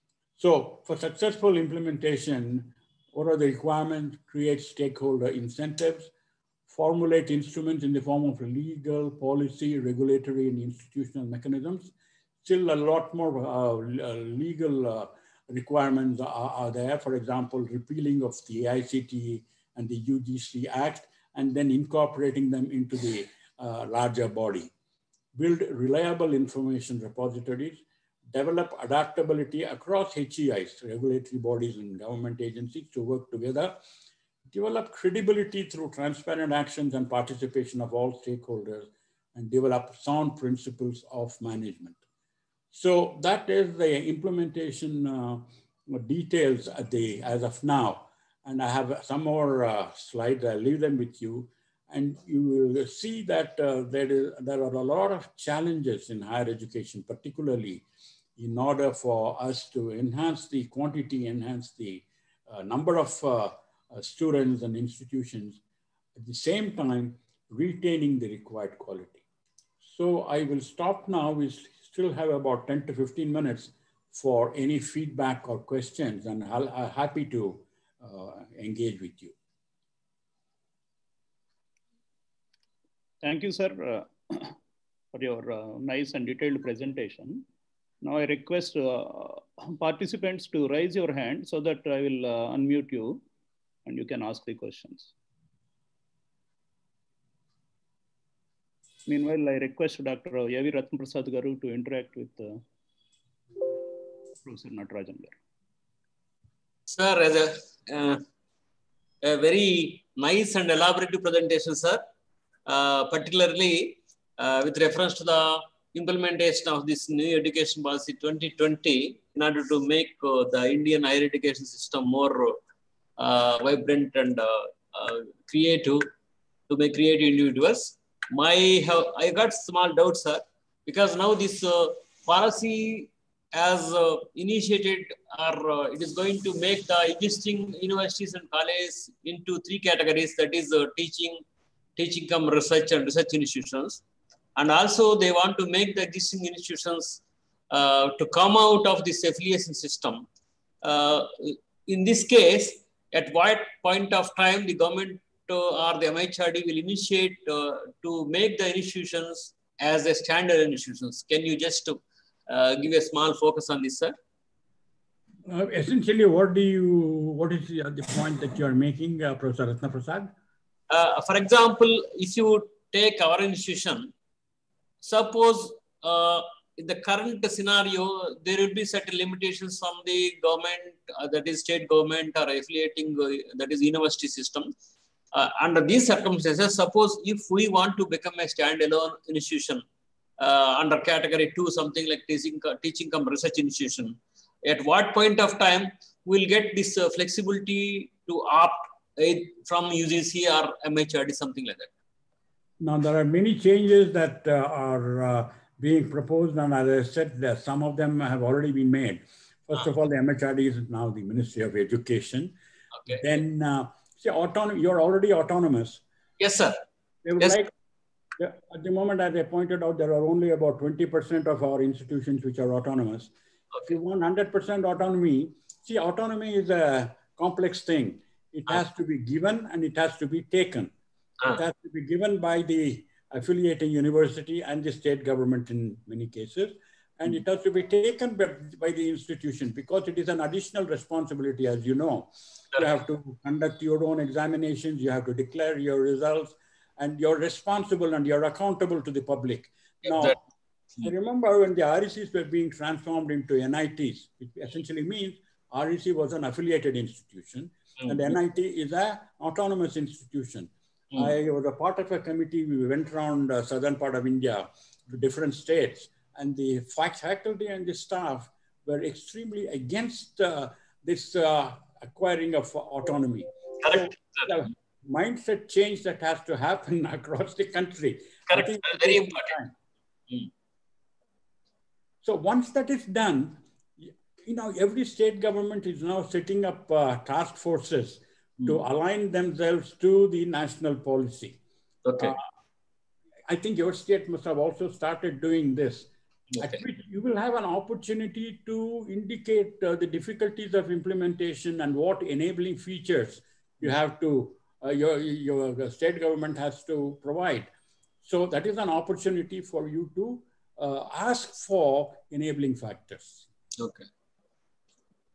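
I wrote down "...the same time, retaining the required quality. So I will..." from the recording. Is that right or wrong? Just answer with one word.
right.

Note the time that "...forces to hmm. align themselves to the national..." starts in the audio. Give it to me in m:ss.
4:47.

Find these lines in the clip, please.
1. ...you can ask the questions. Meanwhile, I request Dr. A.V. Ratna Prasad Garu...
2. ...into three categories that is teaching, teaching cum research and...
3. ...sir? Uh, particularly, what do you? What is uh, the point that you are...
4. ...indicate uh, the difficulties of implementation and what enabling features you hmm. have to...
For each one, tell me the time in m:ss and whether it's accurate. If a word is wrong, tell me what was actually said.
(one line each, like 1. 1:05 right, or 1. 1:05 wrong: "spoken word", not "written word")
1. 1:33 right
2. 2:19 right
3. 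2:43 wrong: "essentially", not "particularly"
4. 4:59 right.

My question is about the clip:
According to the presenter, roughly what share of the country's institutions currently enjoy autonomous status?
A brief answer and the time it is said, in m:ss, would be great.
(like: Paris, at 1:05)
20%, at 3:40.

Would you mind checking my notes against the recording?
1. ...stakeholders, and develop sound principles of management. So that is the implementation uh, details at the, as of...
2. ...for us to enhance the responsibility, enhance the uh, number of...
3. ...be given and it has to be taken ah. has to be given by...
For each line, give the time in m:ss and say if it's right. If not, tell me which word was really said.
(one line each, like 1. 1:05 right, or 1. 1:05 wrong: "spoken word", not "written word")
1. 0:38 right
2. 0:58 wrong: "quantity", not "responsibility"
3. 3:49 right.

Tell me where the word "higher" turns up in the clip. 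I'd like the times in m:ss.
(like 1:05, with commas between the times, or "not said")
0:56, 2:01.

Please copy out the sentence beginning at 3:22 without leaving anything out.
Now, there are many changes that uh, are uh, being proposed, and as I said, some of them have already been made.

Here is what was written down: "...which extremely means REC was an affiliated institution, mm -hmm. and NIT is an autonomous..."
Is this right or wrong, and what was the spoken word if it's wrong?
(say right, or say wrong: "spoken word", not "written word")
wrong: "essentially", not "extremely".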